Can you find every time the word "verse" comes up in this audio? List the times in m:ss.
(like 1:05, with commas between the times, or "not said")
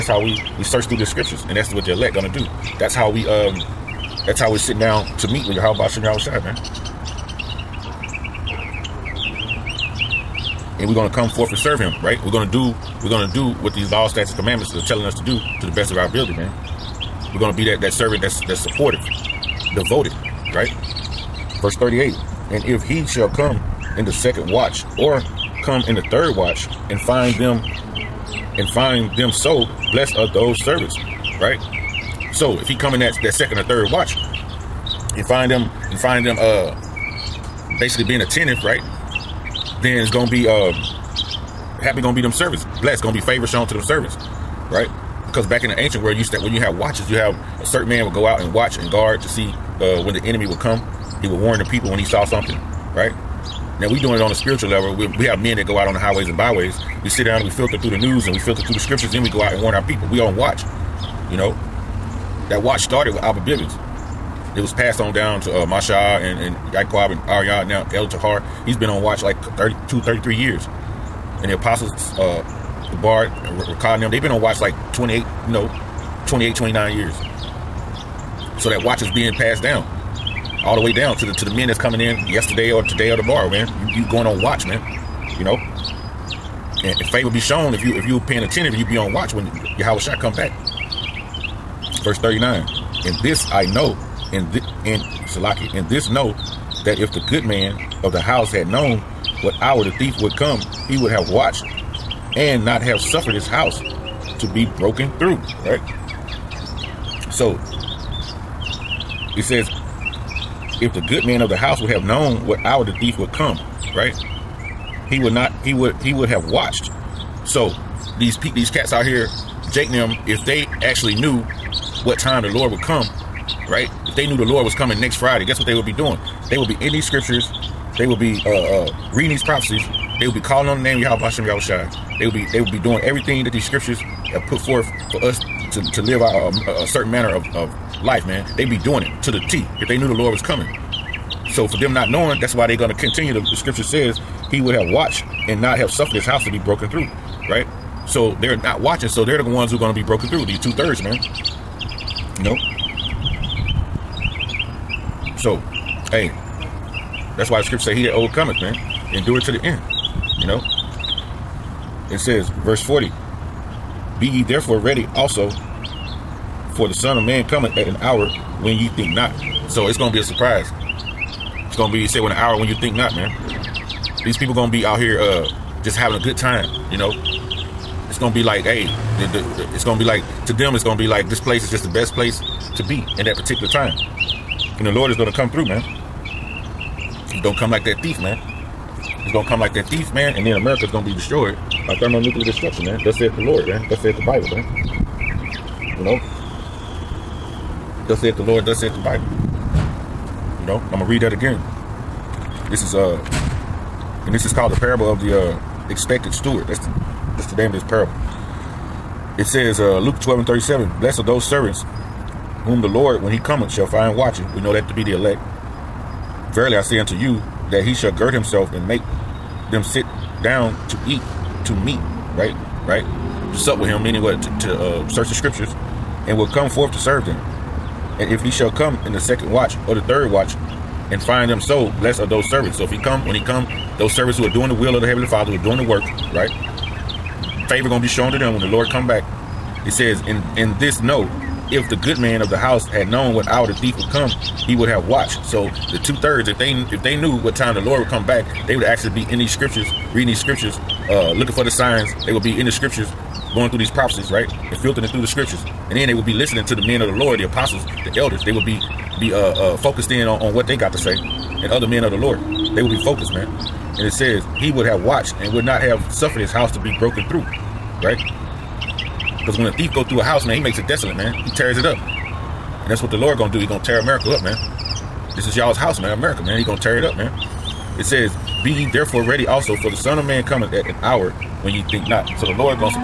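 0:21, 1:32, 2:42.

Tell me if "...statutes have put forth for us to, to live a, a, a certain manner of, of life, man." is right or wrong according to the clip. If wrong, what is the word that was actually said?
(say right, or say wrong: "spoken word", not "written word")
wrong: "scriptures", not "statutes".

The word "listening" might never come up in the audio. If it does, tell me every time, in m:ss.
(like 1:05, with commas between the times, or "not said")
4:16.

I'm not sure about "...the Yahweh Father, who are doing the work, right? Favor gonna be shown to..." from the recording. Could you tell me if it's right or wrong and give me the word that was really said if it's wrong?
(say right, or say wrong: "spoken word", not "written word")
wrong: "Heavenly", not "Yahweh".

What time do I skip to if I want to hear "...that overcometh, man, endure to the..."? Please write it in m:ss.
2:38.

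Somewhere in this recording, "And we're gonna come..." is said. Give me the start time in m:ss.
0:10.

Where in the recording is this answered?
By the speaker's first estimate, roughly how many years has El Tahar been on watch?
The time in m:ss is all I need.
1:09.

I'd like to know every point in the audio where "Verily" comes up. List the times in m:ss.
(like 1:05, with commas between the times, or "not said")
3:36.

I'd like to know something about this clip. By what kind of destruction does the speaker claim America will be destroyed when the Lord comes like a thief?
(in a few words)
Thermonuclear destruction.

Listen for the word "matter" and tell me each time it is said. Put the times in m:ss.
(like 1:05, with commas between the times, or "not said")
not said.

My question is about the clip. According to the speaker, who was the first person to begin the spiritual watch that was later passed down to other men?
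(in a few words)
Albert Bivens.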